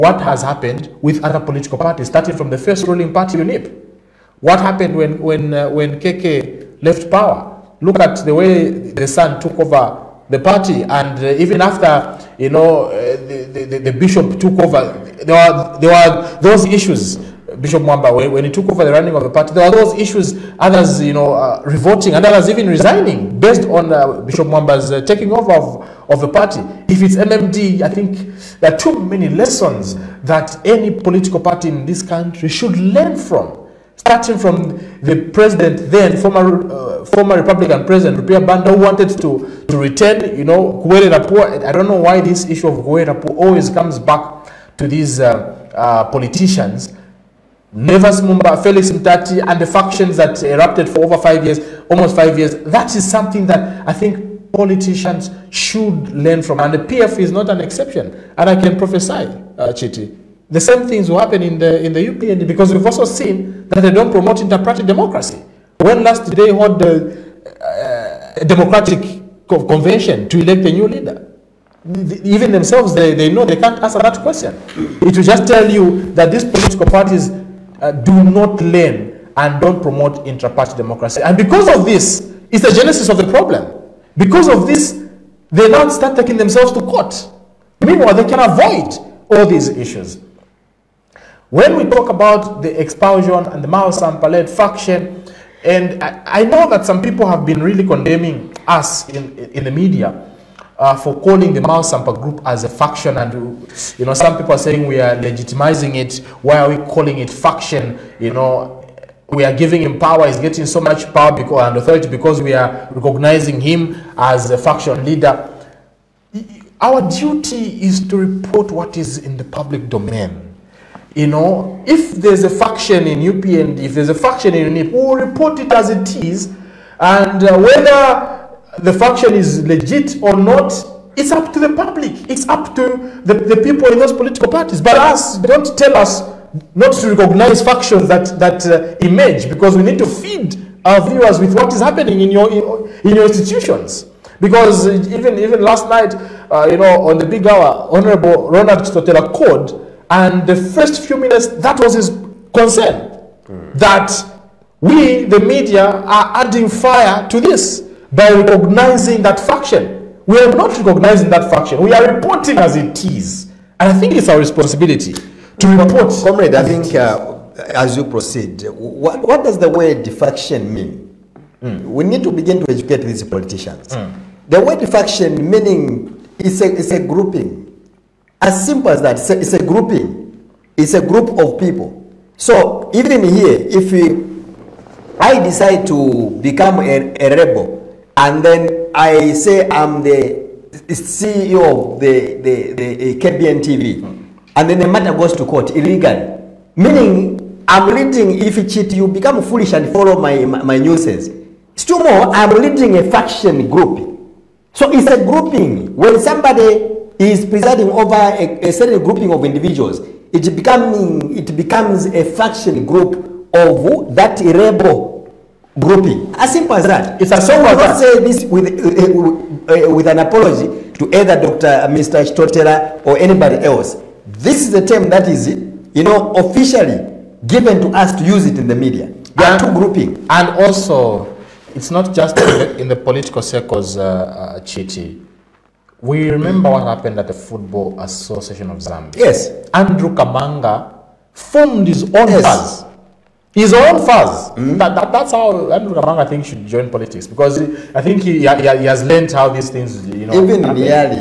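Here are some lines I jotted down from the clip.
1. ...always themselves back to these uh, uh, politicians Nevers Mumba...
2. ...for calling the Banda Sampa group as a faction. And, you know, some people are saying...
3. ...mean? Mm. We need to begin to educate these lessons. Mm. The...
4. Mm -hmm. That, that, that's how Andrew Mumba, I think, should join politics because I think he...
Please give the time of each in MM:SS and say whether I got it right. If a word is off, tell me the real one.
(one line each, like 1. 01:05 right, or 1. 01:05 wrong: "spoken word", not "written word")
1. 00:43 wrong: "comes", not "themselves"
2. 01:40 wrong: "Mao", not "Banda"
3. 02:50 wrong: "politicians", not "lessons"
4. 04:04 wrong: "Kamanga", not "Mumba".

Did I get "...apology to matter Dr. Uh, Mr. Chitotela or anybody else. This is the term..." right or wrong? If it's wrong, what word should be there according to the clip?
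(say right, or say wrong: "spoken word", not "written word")
wrong: "either", not "matter".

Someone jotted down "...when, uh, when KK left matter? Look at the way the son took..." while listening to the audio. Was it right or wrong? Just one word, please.
wrong.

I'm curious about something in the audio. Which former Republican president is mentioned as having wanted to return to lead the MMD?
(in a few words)
Rupia Banda.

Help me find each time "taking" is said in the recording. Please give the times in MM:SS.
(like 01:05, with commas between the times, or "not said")
00:25, 01:26.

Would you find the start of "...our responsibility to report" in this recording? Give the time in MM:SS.
02:44.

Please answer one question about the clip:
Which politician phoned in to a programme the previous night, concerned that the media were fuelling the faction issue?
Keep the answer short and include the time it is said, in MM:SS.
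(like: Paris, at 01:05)
Ronald Chitotela, at 02:28.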